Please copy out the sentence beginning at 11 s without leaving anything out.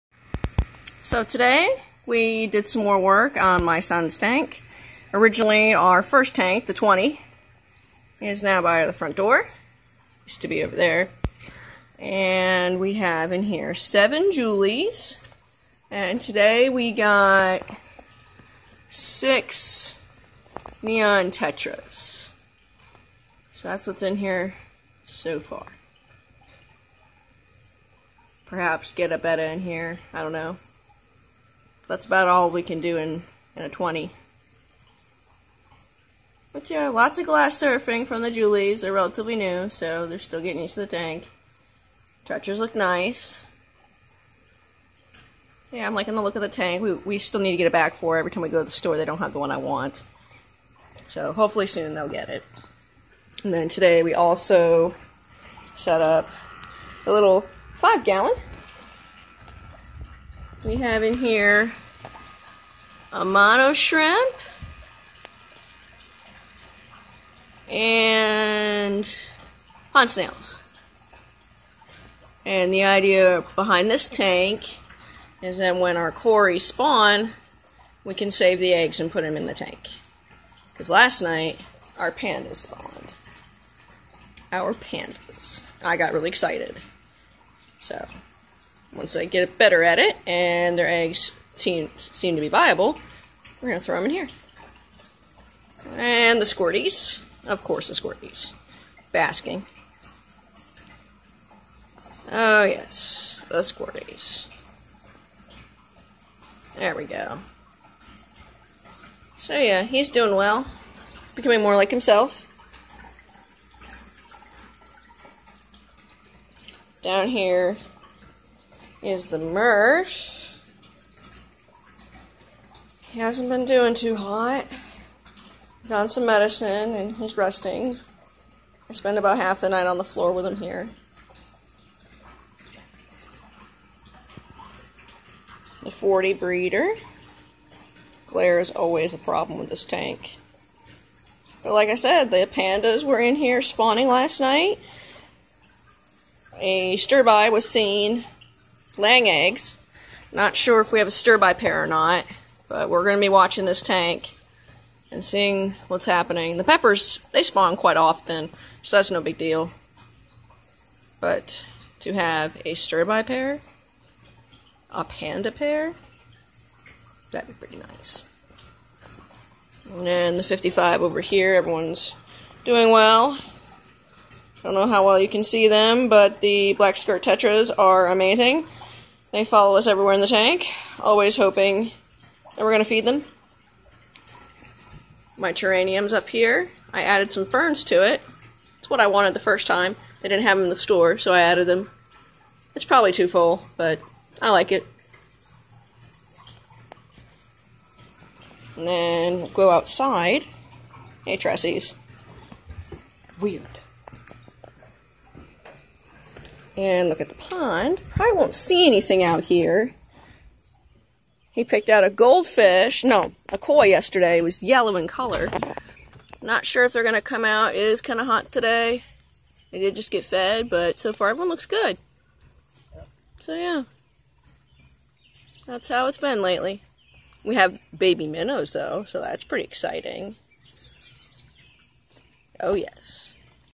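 And we have in here seven Julies.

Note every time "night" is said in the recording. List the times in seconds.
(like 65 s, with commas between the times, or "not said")
81 s, 129 s, 144 s.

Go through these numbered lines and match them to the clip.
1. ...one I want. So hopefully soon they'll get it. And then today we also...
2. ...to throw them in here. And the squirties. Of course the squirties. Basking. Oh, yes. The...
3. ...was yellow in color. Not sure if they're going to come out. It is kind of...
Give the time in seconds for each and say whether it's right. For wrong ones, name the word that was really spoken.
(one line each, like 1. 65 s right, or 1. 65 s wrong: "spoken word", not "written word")
1. 49 s right
2. 93 s right
3. 214 s right.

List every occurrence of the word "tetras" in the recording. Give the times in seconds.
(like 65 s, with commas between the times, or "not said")
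21 s, 177 s.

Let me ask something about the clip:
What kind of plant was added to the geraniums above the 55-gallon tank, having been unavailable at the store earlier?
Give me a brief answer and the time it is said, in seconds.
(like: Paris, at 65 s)
Ferns, at 187 s.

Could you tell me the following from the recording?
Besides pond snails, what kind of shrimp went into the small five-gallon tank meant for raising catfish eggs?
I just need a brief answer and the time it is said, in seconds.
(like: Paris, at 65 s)
Amano shrimp, at 63 s.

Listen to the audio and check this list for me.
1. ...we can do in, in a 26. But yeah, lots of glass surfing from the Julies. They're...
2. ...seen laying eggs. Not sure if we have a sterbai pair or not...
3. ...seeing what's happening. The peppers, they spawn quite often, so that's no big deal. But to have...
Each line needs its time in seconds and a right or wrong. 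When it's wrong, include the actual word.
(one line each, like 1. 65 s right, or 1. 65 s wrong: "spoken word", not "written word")
1. 32 s wrong: "20", not "26"
2. 147 s right
3. 155 s right.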